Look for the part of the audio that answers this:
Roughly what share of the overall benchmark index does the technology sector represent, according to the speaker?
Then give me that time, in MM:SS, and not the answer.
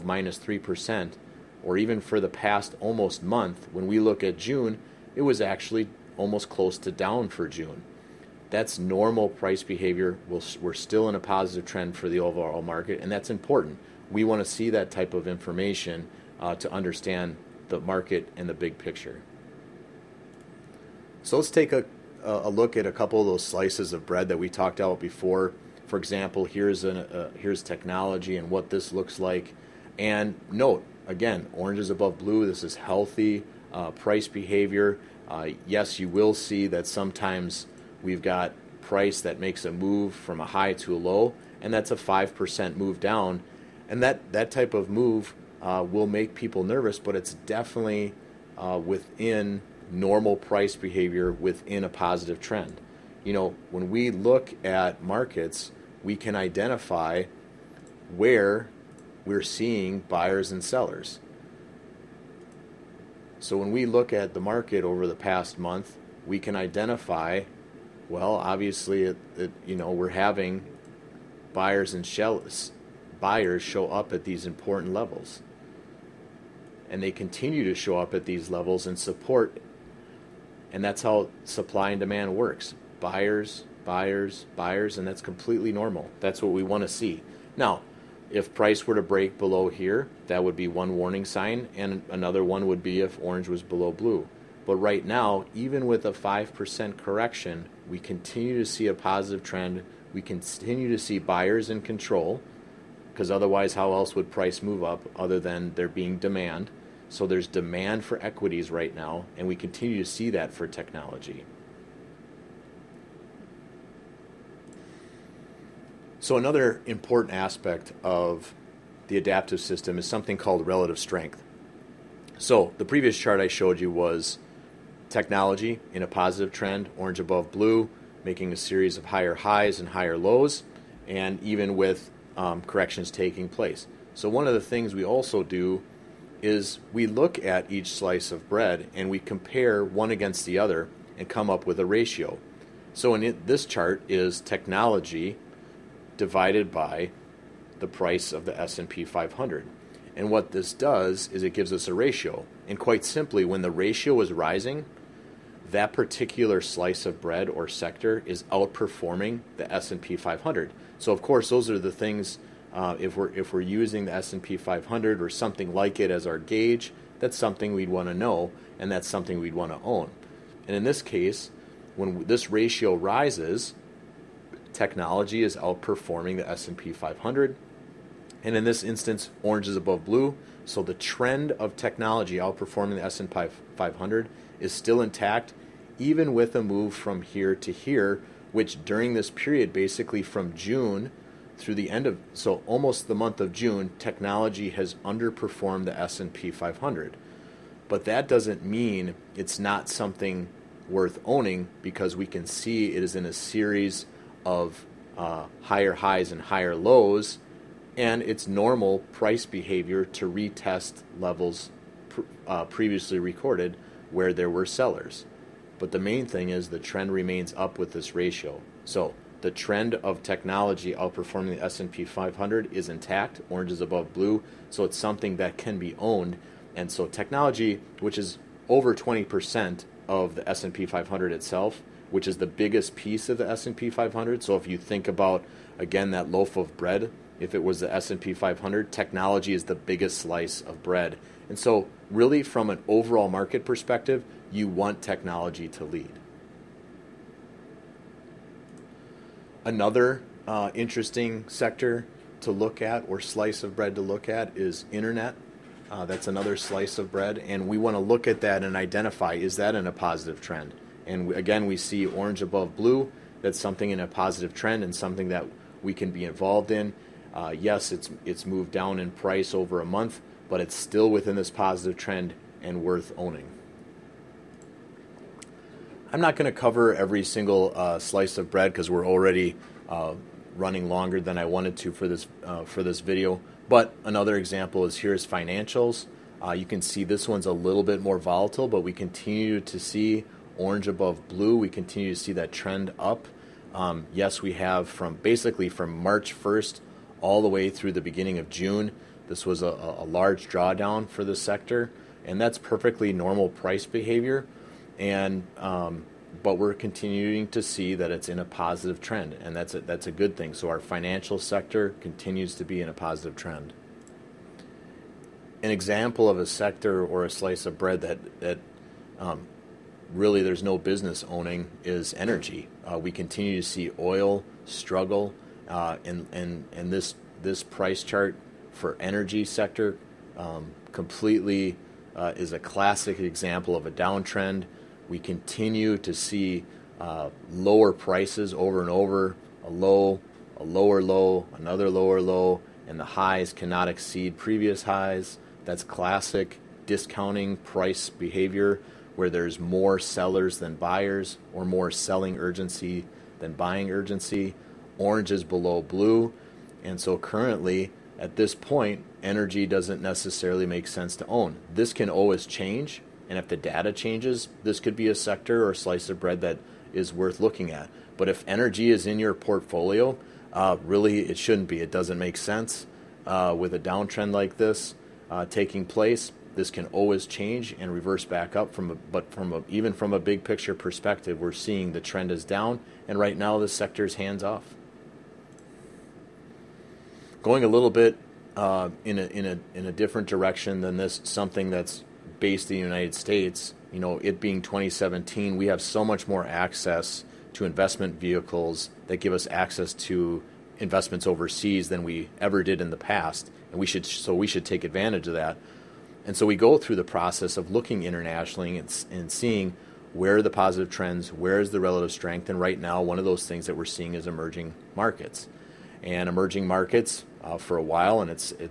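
03:48.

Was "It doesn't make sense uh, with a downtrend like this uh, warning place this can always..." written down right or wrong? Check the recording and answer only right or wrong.
wrong.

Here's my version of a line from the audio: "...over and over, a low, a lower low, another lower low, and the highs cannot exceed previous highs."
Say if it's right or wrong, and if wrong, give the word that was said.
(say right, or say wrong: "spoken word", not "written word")
right.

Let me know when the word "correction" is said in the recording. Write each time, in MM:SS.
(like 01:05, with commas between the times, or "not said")
01:36, 02:12.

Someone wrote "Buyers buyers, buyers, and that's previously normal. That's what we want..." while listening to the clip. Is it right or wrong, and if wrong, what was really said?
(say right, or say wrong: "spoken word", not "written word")
wrong: "completely", not "previously".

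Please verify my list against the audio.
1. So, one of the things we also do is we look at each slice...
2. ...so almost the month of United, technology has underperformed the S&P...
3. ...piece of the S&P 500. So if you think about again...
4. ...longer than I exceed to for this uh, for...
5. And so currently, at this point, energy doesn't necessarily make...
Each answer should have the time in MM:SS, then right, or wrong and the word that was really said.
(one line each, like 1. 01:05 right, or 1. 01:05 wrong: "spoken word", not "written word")
1. 02:14 right
2. 03:12 wrong: "June", not "United"
3. 03:52 right
4. 04:40 wrong: "wanted", not "exceed"
5. 05:56 right.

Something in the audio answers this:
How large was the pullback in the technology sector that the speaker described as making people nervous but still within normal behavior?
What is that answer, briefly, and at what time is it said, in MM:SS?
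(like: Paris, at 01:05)
5%, at 00:41.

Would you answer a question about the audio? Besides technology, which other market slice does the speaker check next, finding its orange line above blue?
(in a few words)
internet.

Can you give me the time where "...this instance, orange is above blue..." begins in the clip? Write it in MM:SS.
02:58.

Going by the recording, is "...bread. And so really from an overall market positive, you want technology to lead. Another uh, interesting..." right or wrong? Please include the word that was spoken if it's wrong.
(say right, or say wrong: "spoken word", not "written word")
wrong: "perspective", not "positive".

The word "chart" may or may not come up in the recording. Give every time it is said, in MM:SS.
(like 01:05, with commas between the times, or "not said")
02:03, 02:23, 05:28.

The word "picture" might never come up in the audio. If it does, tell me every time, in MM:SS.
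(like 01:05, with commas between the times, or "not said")
00:18, 06:20.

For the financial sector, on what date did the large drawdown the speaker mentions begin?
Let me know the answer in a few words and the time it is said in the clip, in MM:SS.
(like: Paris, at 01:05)
March 1st, at 04:56.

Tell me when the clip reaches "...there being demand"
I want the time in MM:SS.
01:45.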